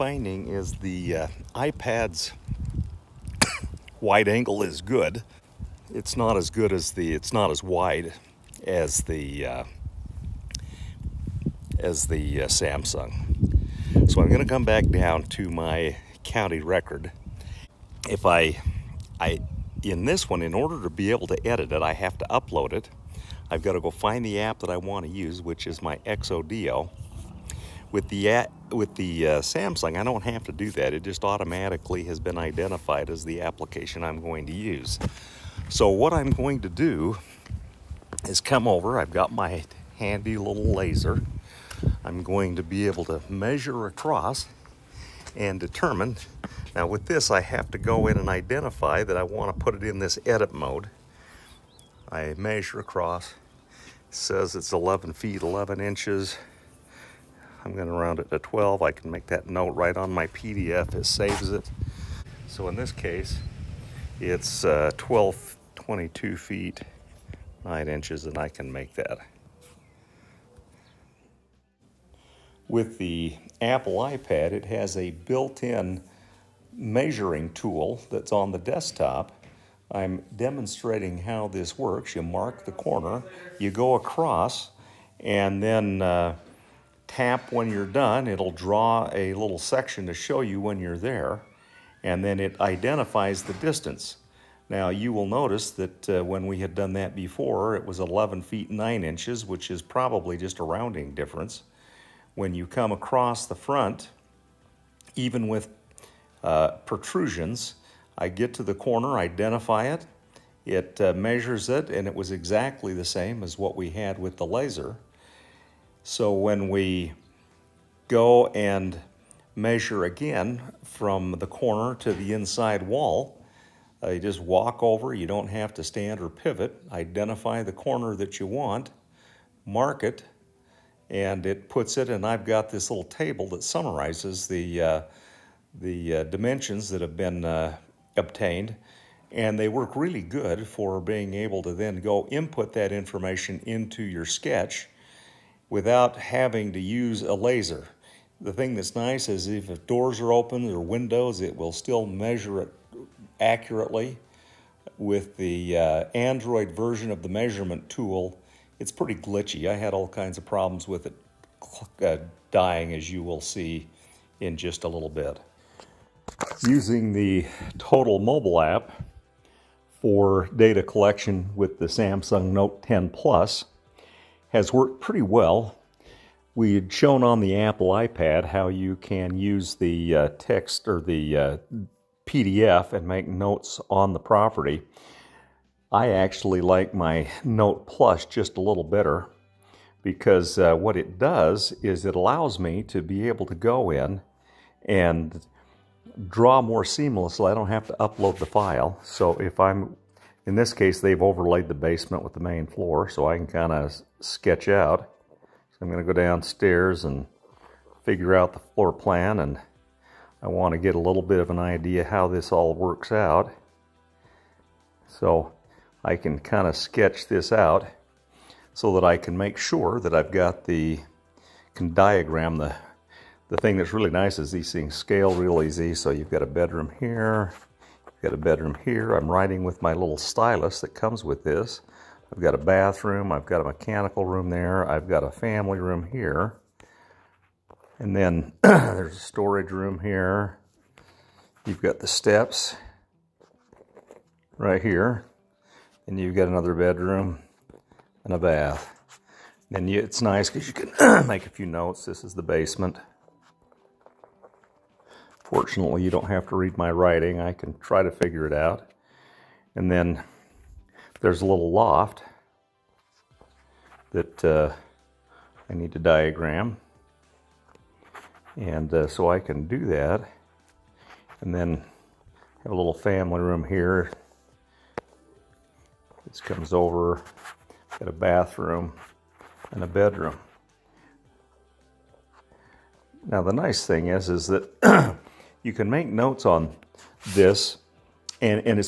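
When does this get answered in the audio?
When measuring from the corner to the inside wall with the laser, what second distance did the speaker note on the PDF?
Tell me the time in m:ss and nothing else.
1:05.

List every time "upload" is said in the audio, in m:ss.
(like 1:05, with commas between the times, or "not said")
0:22, 3:17.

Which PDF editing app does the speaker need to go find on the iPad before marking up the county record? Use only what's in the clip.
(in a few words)
XODO.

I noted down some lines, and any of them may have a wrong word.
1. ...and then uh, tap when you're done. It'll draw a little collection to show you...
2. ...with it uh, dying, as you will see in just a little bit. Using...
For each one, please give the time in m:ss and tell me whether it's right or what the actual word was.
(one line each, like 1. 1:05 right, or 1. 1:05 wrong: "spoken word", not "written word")
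1. 1:25 wrong: "section", not "collection"
2. 2:40 right.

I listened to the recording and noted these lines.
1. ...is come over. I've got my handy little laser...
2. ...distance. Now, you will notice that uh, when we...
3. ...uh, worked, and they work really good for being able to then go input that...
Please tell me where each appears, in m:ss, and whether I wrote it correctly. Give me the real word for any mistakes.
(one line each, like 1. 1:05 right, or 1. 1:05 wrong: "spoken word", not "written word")
1. 0:38 right
2. 1:33 right
3. 2:17 wrong: "obtained", not "worked".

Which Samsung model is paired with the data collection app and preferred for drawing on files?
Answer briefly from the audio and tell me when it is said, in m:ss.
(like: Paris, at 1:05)
Note 10 Plus, at 2:52.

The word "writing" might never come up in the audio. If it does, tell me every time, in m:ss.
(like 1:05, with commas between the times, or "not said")
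3:49, 4:16.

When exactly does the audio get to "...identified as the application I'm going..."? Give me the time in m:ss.
0:32.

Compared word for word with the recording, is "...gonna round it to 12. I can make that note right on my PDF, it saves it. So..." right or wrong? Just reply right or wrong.
right.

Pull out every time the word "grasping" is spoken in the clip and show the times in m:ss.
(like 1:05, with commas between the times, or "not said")
not said.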